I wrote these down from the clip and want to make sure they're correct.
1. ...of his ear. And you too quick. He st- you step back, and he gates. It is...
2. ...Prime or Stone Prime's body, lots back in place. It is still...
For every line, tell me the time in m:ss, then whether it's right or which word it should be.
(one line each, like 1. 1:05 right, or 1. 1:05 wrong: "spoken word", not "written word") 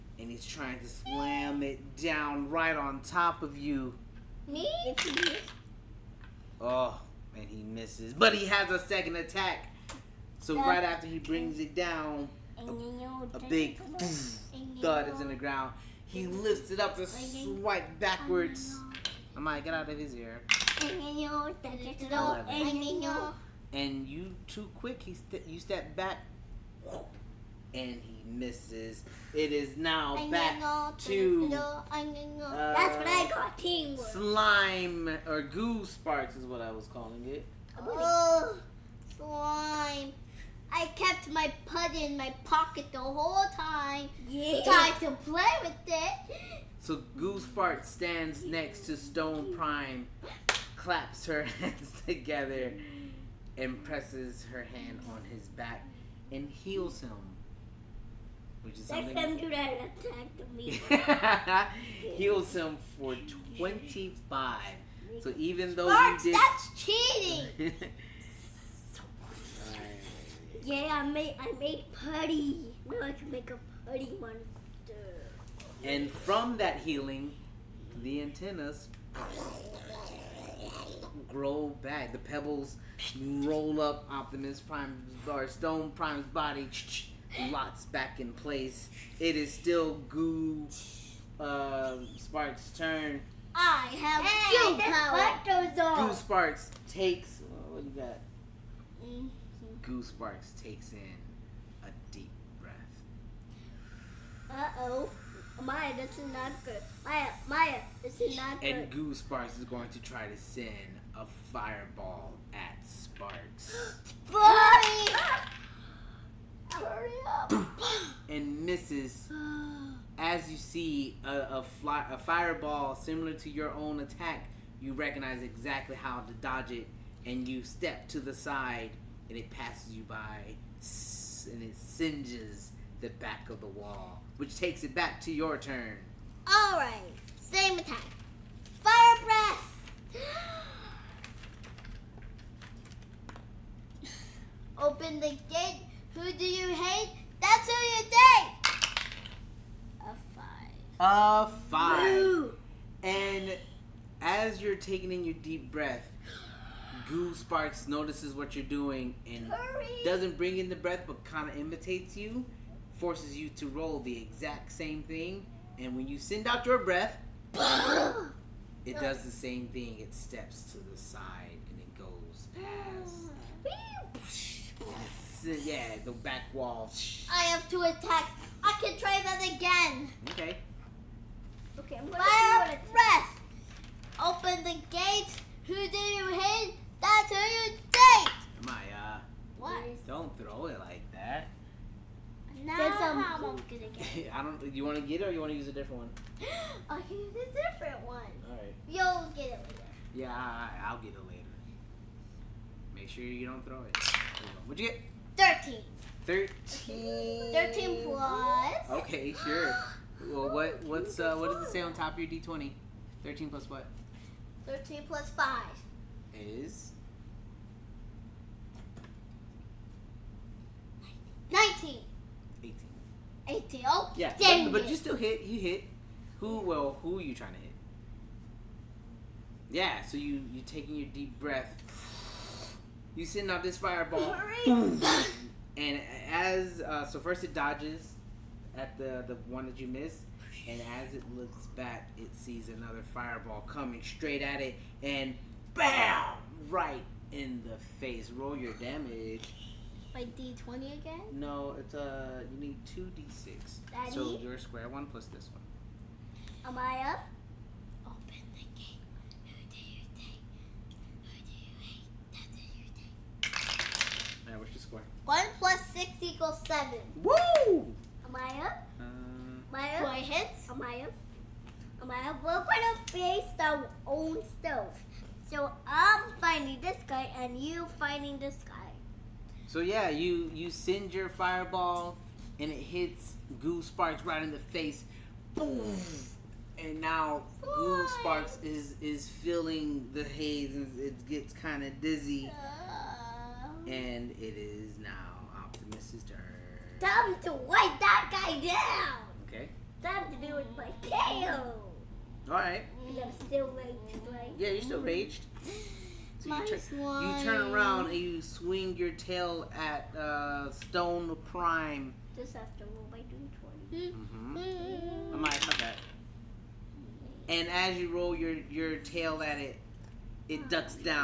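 1. 0:19 wrong: "misses", not "gates"
2. 1:24 right.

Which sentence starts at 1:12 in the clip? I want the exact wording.
Now I can make a putty monster.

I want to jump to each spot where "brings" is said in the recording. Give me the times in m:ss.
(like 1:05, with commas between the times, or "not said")
0:11, 2:40.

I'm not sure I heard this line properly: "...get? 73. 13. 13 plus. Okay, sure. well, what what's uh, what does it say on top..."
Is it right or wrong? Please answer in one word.
wrong.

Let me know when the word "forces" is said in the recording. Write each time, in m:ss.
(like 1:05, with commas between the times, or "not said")
2:42.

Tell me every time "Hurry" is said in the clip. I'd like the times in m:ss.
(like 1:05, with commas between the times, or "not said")
1:56, 2:39.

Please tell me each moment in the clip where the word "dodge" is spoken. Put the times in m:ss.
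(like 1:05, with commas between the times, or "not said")
2:06, 3:57.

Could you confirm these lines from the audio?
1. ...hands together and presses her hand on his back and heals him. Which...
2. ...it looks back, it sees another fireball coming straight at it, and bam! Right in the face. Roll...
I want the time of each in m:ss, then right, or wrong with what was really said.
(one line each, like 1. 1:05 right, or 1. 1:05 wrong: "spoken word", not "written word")
1. 0:51 right
2. 4:01 right.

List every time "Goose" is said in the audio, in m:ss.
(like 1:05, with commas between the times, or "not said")
0:47, 1:48.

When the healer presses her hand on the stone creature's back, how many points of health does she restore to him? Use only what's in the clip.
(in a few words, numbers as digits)
25.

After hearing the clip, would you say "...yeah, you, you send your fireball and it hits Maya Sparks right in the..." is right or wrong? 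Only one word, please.
wrong.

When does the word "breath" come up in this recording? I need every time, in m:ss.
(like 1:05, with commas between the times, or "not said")
1:42, 2:19, 2:35, 2:40, 2:46, 3:02, 3:51.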